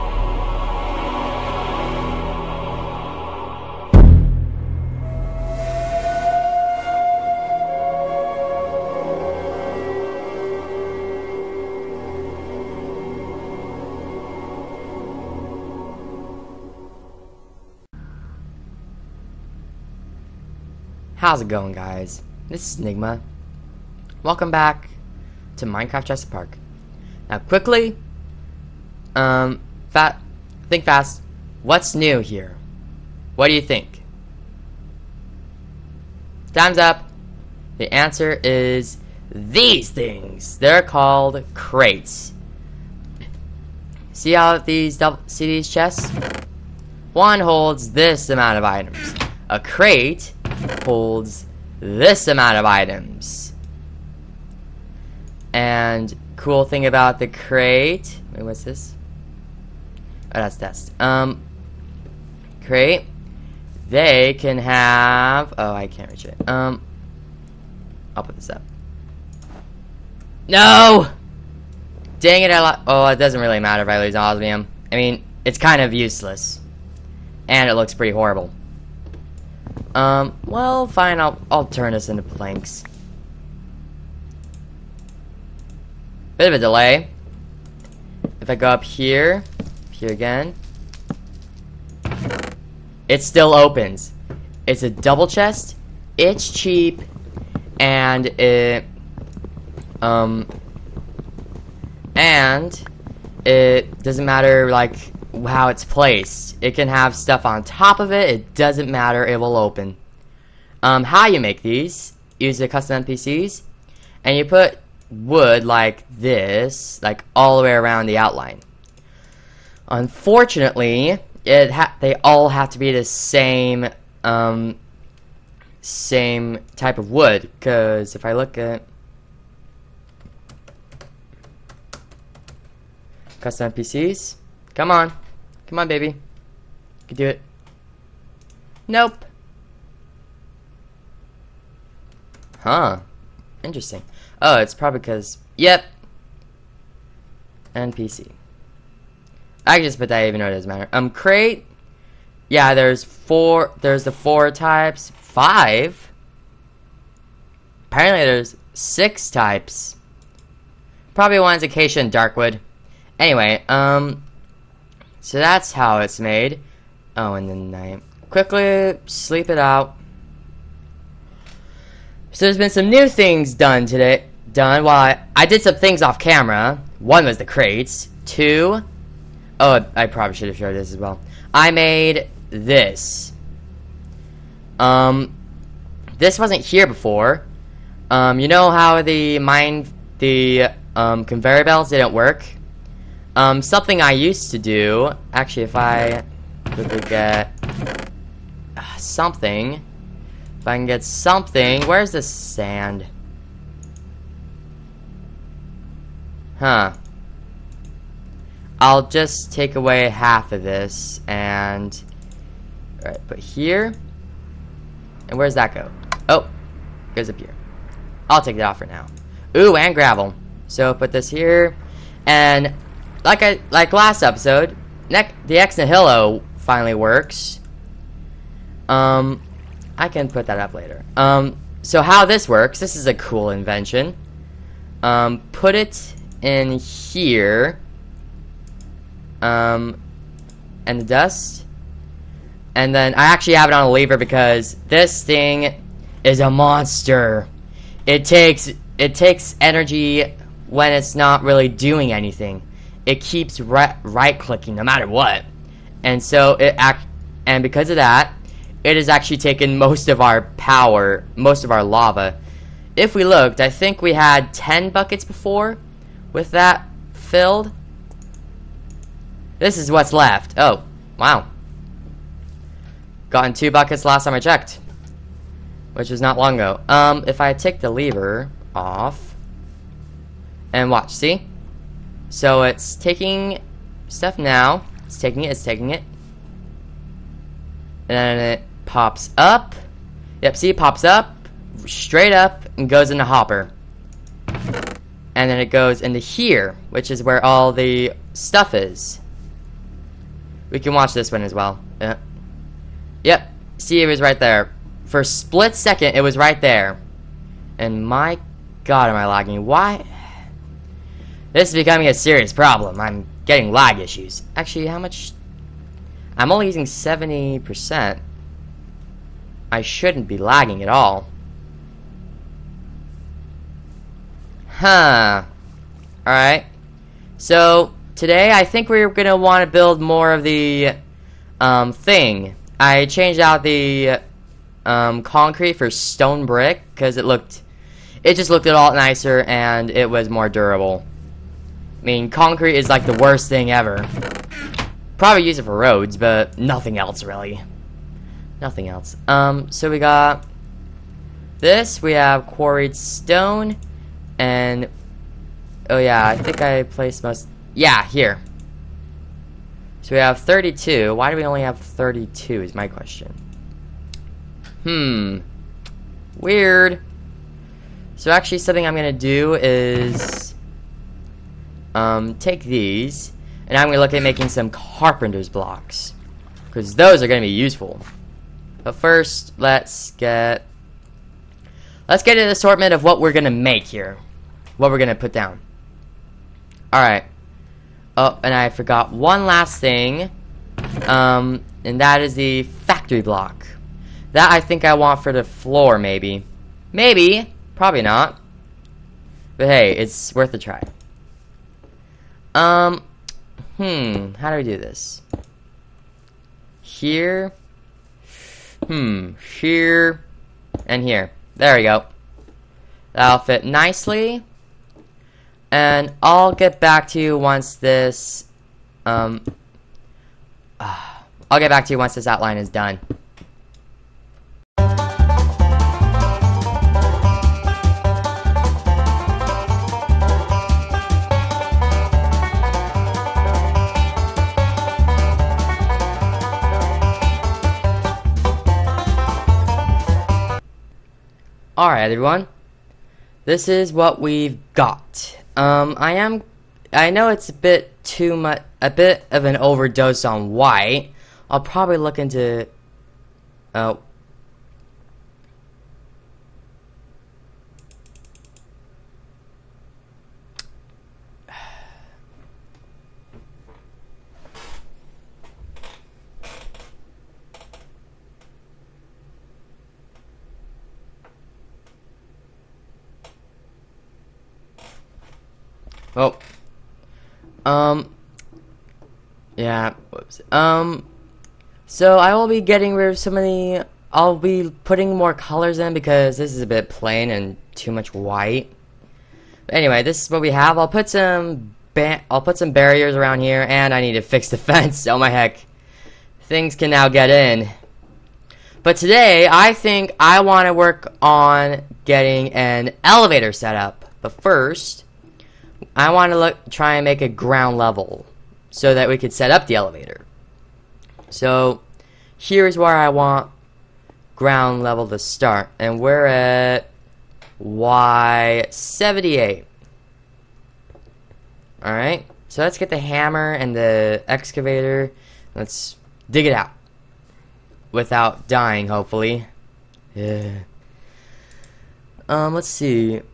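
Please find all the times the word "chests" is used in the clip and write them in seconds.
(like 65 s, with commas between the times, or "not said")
45 s, 95 s.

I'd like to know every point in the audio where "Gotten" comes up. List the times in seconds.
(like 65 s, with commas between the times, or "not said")
273 s.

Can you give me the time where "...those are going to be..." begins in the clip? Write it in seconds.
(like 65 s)
376 s.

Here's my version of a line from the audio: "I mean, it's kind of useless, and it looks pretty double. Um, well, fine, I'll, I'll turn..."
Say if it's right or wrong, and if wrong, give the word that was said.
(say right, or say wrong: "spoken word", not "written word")
wrong: "horrible", not "double".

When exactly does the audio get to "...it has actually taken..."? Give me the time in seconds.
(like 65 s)
258 s.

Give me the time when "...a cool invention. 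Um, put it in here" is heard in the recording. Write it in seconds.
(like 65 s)
233 s.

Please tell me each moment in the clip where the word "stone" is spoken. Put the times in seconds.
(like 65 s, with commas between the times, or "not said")
335 s, 352 s.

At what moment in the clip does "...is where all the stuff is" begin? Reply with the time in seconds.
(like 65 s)
297 s.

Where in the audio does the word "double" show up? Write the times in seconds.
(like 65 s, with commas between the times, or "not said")
44 s, 94 s.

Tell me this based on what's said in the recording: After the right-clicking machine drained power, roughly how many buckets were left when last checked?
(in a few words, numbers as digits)
2.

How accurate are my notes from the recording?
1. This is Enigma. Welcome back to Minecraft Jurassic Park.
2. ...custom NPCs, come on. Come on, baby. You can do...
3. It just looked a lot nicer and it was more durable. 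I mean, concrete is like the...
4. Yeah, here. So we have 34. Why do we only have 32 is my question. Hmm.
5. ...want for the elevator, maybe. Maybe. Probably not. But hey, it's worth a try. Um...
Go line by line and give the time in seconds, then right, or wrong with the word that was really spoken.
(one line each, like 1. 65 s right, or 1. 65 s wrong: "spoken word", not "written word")
1. 22 s right
2. 133 s right
3. 338 s right
4. 357 s wrong: "32", not "34"
5. 394 s wrong: "floor", not "elevator".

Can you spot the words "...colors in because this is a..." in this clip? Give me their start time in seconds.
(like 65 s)
485 s.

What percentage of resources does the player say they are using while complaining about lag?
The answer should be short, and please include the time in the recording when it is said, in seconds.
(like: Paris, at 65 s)
70%, at 316 s.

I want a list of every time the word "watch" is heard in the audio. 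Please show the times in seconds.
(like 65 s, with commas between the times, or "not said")
280 s, 300 s.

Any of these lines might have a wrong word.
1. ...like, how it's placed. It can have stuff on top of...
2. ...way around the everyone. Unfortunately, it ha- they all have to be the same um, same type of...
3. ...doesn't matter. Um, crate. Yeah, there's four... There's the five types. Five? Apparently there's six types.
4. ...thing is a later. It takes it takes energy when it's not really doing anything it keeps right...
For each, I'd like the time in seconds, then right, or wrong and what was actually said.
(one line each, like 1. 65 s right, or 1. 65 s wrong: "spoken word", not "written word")
1. 104 s right
2. 117 s wrong: "outline", not "everyone"
3. 150 s wrong: "four", not "five"
4. 245 s wrong: "monster", not "later".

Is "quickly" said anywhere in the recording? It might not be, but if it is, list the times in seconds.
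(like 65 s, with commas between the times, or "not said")
27 s, 168 s.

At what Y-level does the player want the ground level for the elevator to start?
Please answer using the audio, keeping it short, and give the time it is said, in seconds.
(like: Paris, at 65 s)
78, at 517 s.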